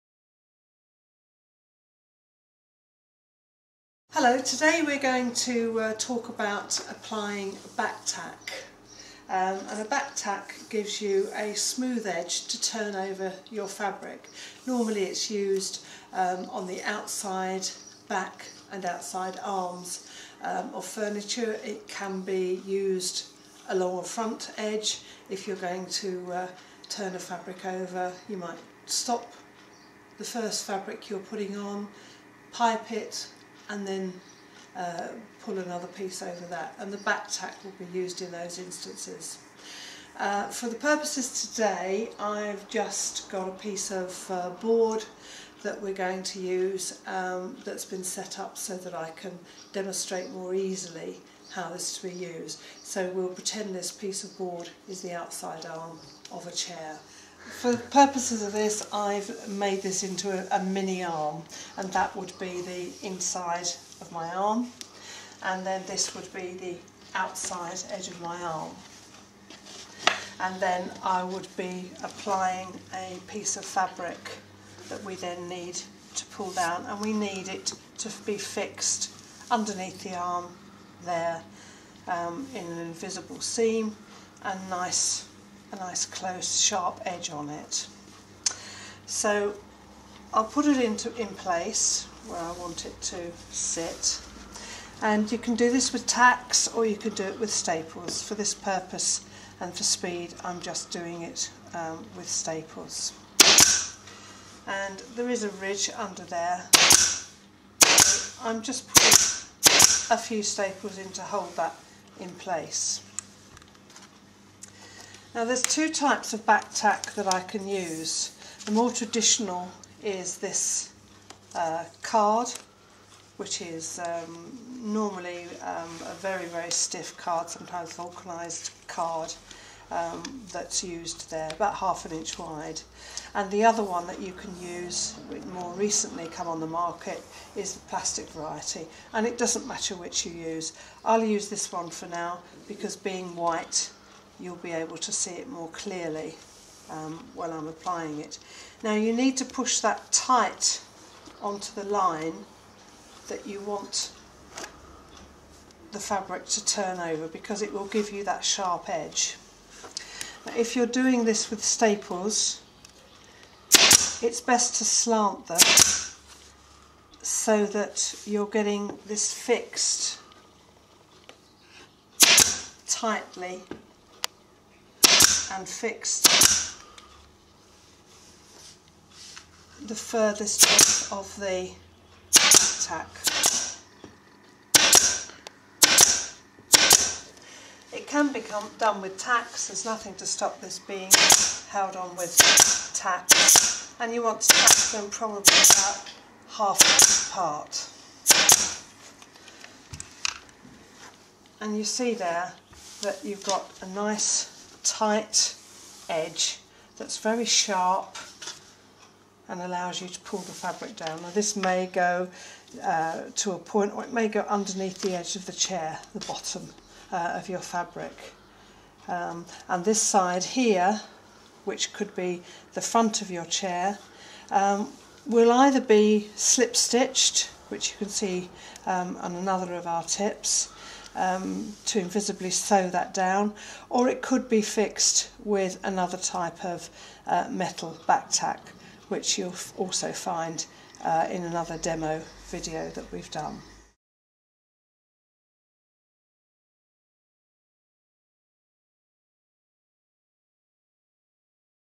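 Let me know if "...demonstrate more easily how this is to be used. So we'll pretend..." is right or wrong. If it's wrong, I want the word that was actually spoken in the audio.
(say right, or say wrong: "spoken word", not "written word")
right.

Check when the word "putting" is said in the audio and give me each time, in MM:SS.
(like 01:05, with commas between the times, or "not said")
00:31, 01:48.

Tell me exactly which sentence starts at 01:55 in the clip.
Now there's two types of back tack that I can use.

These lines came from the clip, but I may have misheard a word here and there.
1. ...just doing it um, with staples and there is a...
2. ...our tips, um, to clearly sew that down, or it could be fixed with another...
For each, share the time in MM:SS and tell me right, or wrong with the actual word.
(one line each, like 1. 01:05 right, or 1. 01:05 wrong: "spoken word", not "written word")
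1. 01:40 right
2. 03:49 wrong: "invisibly", not "clearly".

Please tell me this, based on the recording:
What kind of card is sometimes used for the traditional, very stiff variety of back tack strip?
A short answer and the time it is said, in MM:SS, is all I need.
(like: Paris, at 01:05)
Vulcanized card, at 02:07.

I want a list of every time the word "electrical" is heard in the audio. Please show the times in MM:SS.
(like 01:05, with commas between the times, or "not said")
not said.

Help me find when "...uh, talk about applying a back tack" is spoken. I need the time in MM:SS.
00:05.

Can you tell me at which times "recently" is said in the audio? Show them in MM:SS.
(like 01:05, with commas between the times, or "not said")
02:15.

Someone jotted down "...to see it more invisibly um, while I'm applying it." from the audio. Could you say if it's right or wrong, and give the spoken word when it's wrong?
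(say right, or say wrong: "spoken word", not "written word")
wrong: "clearly", not "invisibly".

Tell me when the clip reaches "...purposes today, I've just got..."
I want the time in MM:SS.
00:40.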